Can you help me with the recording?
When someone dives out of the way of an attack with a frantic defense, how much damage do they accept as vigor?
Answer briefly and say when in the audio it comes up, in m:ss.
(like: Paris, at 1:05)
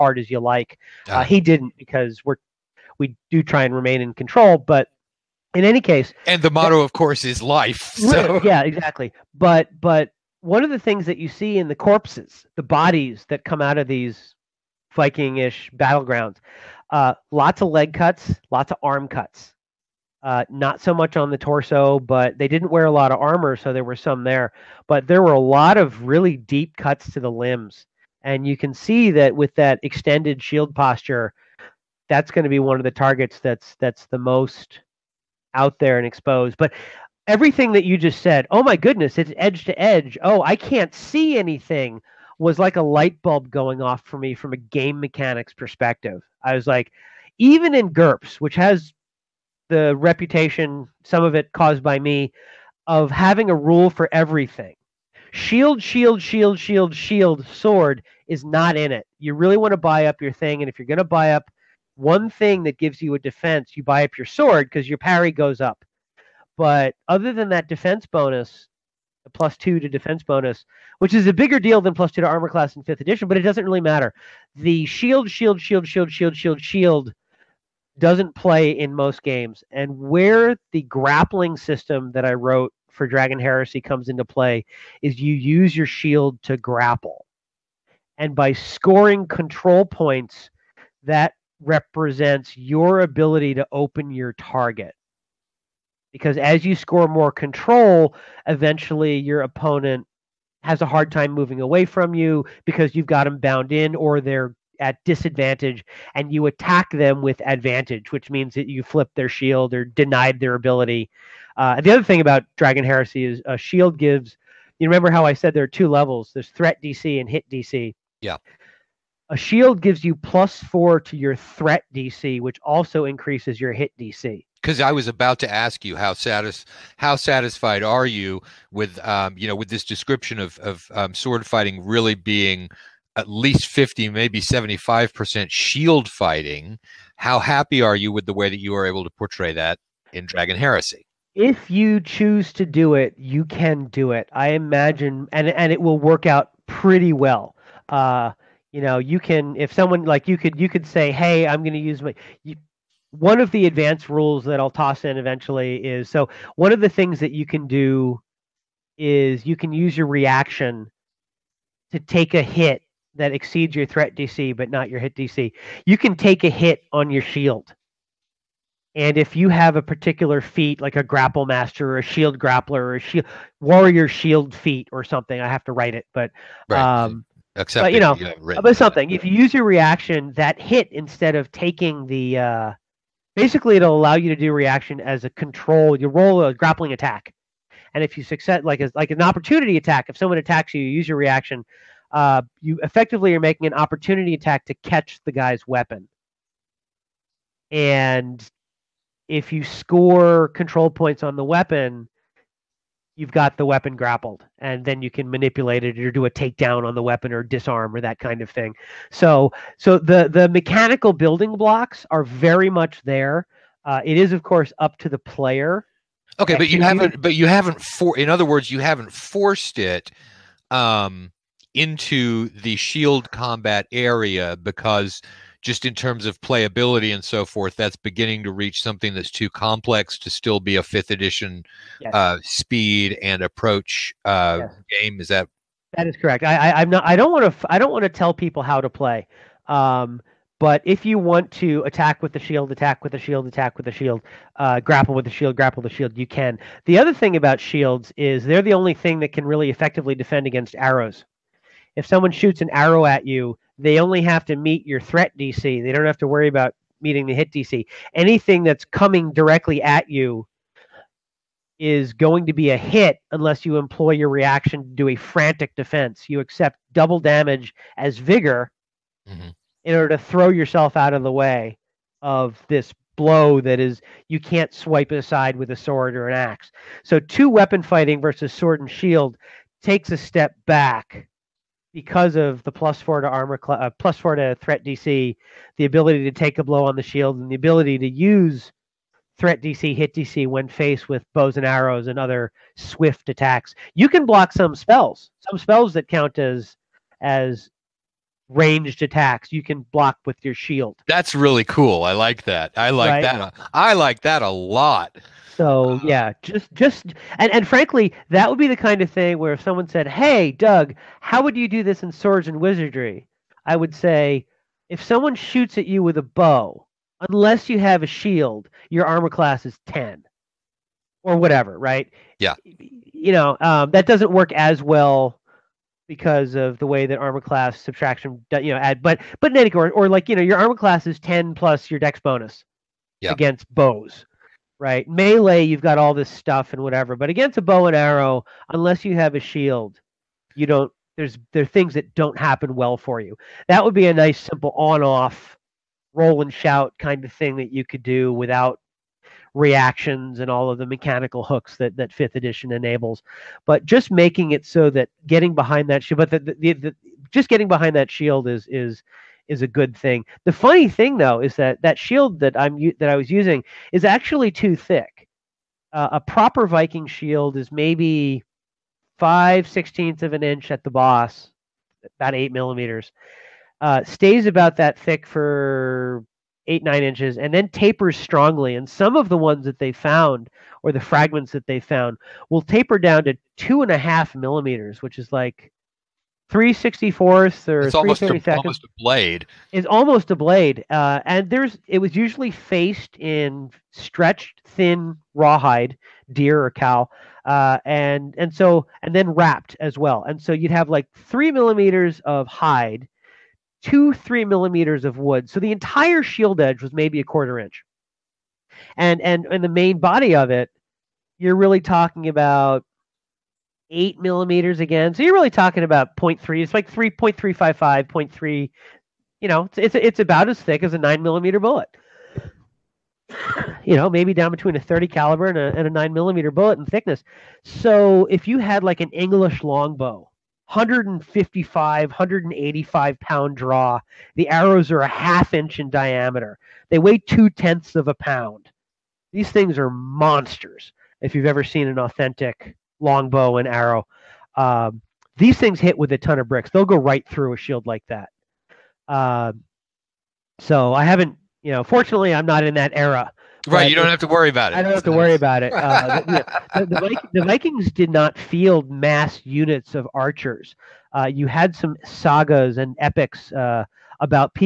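Double damage, at 4:26.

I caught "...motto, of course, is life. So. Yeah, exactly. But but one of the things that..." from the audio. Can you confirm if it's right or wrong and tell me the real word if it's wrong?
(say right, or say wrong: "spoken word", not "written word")
right.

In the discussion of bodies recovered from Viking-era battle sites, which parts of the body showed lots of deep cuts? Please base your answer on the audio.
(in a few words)
Limbs.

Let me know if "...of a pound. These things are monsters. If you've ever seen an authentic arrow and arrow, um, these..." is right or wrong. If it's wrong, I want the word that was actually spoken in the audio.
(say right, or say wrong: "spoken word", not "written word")
wrong: "longbow", not "arrow".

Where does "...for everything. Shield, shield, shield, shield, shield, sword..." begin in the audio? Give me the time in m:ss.
0:53.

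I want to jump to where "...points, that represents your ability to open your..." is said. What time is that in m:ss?
1:29.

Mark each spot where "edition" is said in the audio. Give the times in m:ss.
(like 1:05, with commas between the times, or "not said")
1:13, 3:51, 5:52.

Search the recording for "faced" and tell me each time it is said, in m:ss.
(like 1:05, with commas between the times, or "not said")
4:50, 6:32.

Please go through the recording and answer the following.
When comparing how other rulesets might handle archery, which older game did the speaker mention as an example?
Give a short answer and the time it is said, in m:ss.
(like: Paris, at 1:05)
Swords and Wizardry, at 5:12.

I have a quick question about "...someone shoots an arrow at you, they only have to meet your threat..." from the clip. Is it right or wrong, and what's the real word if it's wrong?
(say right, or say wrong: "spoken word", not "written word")
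right.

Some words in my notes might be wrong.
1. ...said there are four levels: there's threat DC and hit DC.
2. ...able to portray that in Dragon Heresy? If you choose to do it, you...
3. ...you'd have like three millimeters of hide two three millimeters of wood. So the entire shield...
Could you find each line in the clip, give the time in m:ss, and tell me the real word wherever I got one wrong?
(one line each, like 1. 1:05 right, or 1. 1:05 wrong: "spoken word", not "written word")
1. 1:55 wrong: "two", not "four"
2. 2:18 right
3. 6:40 right.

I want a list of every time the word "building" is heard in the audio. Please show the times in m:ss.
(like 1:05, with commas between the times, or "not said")
3:31.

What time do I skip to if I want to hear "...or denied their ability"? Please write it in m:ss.
1:49.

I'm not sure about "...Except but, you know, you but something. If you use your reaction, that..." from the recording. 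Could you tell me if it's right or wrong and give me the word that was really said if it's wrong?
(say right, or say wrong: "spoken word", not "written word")
right.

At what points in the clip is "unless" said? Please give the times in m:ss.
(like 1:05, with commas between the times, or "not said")
4:23, 5:17, 5:38.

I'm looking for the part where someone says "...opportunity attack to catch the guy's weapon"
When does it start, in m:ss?
3:13.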